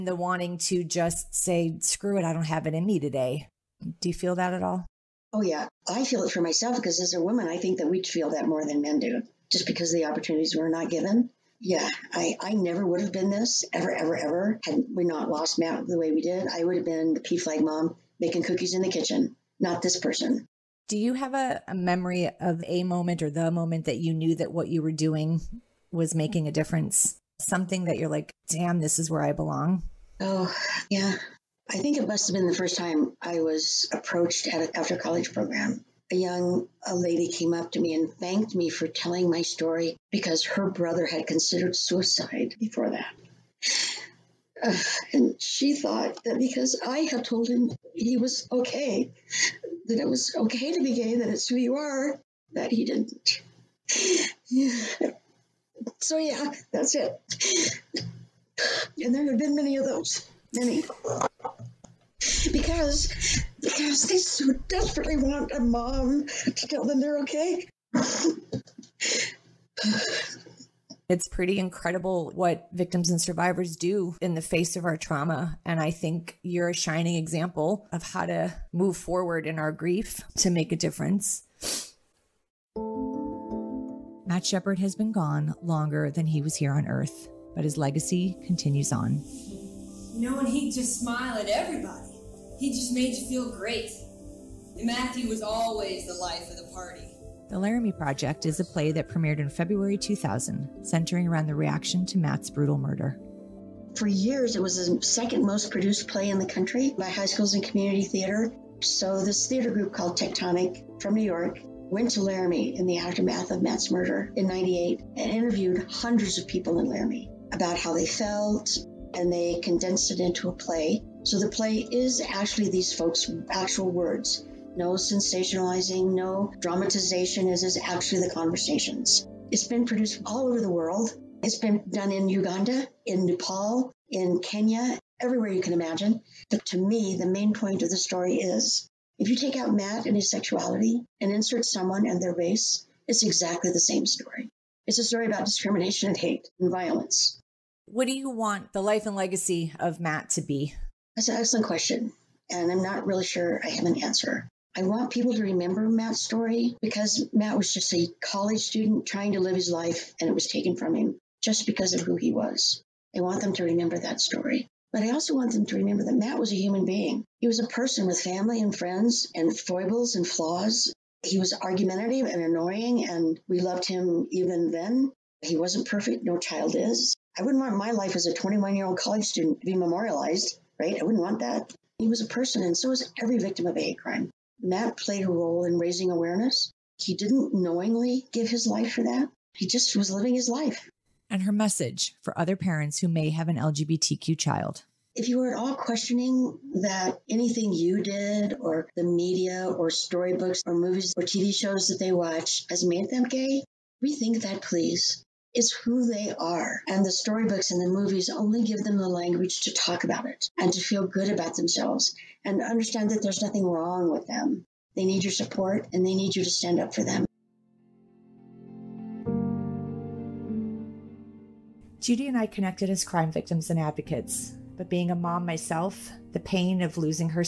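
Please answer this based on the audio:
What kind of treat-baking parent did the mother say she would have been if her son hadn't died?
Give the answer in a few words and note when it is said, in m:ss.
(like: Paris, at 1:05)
PFLAG mom, at 0:17.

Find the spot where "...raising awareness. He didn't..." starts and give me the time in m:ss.
3:05.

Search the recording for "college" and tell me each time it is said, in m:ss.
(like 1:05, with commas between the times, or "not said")
0:34, 2:38, 2:58.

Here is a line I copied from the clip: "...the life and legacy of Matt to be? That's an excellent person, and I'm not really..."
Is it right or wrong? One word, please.
wrong.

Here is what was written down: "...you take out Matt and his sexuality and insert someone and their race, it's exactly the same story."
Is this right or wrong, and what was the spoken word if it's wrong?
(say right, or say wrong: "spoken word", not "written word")
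right.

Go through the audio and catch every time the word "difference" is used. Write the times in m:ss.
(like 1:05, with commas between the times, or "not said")
0:26, 1:20.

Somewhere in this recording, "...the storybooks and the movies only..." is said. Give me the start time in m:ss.
3:27.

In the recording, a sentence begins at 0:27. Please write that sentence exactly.
Something that you're like, damn, this is where I belong?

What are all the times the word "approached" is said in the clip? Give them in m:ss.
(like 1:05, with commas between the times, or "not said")
0:33.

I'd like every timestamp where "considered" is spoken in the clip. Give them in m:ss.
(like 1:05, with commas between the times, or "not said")
0:41.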